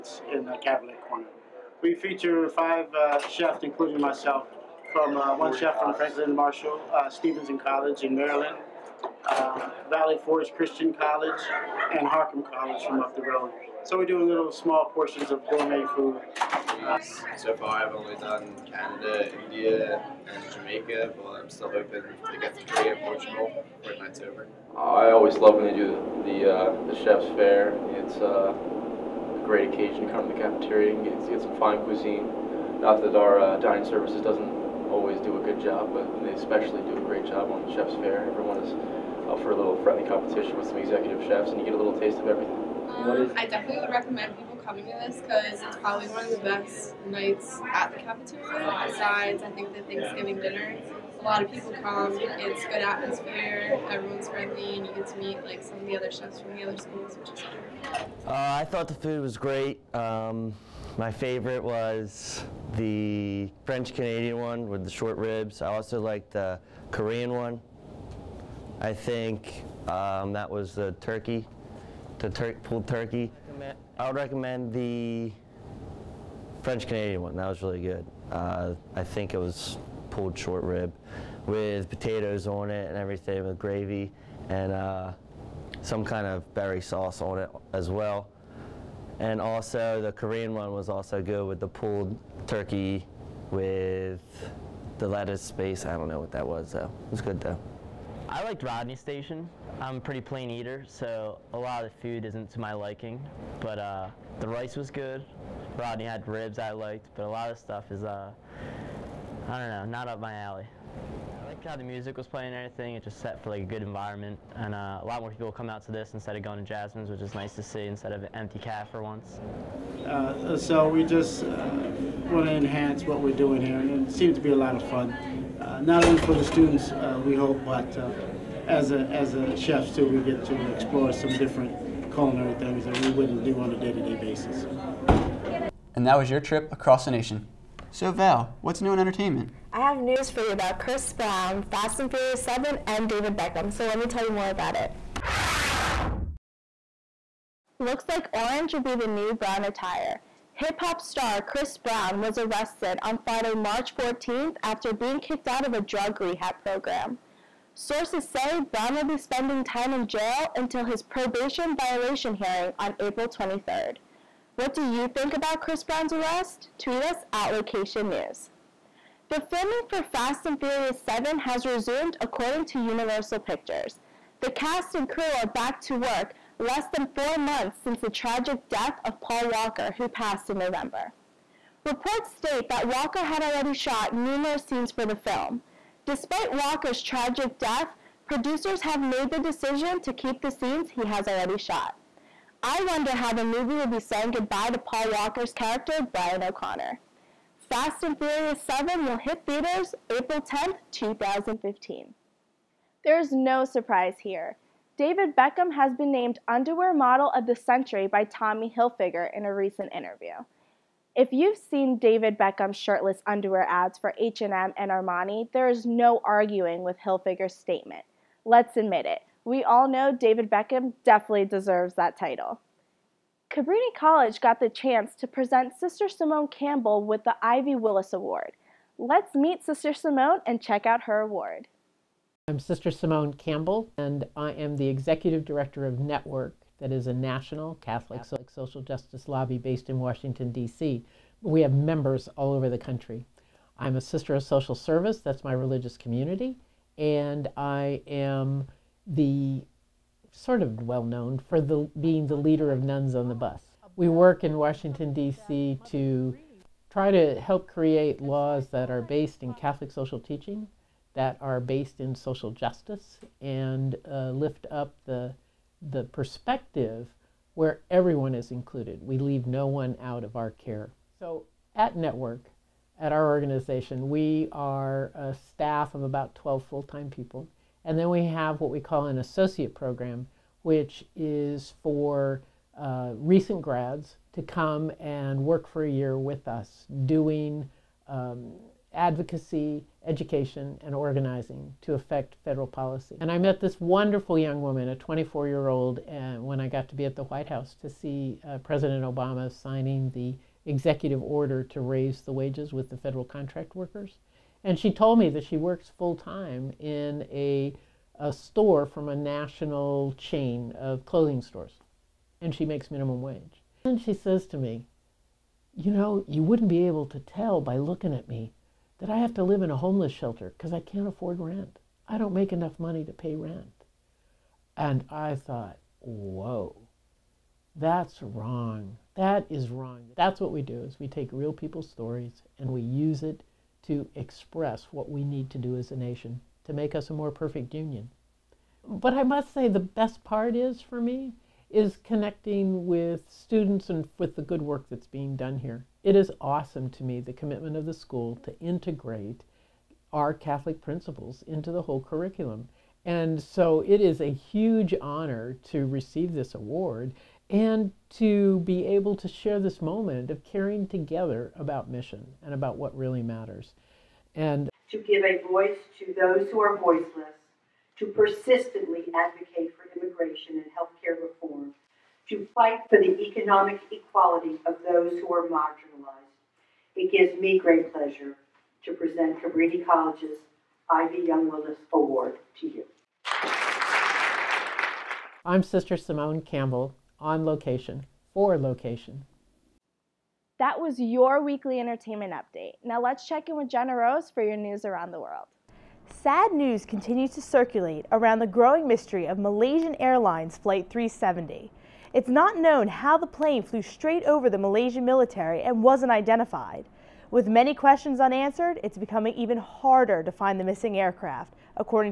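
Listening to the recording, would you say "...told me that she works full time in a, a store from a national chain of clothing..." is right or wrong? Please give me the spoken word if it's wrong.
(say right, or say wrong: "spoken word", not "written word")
right.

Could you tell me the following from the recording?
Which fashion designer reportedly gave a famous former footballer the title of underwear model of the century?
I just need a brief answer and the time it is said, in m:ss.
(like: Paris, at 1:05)
Tommy Hilfiger, at 3:28.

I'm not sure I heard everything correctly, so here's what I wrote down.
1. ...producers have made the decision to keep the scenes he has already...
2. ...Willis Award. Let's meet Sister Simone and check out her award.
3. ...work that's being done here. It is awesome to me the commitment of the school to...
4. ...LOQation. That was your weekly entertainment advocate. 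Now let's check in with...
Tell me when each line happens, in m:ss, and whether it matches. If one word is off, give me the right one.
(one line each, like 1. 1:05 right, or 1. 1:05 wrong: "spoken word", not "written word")
1. 3:08 right
2. 3:47 right
3. 5:44 right
4. 6:28 wrong: "update", not "advocate".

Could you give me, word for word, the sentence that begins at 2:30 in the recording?
Hip hop star Chris Brown was arrested on Friday, March 14th after being kicked out of a drug rehab program.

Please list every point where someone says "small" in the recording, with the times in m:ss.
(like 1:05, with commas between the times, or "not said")
0:14.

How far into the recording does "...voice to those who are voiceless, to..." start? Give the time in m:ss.
6:05.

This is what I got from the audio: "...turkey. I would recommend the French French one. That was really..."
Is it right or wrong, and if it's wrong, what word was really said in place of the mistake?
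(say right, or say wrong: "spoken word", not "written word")
wrong: "Canadian", not "French".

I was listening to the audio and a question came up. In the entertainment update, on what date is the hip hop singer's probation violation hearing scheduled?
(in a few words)
April 23.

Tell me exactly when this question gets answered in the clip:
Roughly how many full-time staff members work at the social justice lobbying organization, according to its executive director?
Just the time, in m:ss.
4:36.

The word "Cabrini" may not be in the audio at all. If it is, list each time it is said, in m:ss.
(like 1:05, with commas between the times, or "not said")
3:43, 6:19.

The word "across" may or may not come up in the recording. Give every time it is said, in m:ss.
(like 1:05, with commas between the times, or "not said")
2:16.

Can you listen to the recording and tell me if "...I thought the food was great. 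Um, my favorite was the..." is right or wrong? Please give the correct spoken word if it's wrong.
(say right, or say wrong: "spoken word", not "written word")
right.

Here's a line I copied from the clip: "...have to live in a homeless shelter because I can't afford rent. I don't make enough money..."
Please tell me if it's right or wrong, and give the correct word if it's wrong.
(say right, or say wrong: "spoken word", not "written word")
right.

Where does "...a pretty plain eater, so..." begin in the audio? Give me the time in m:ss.
1:39.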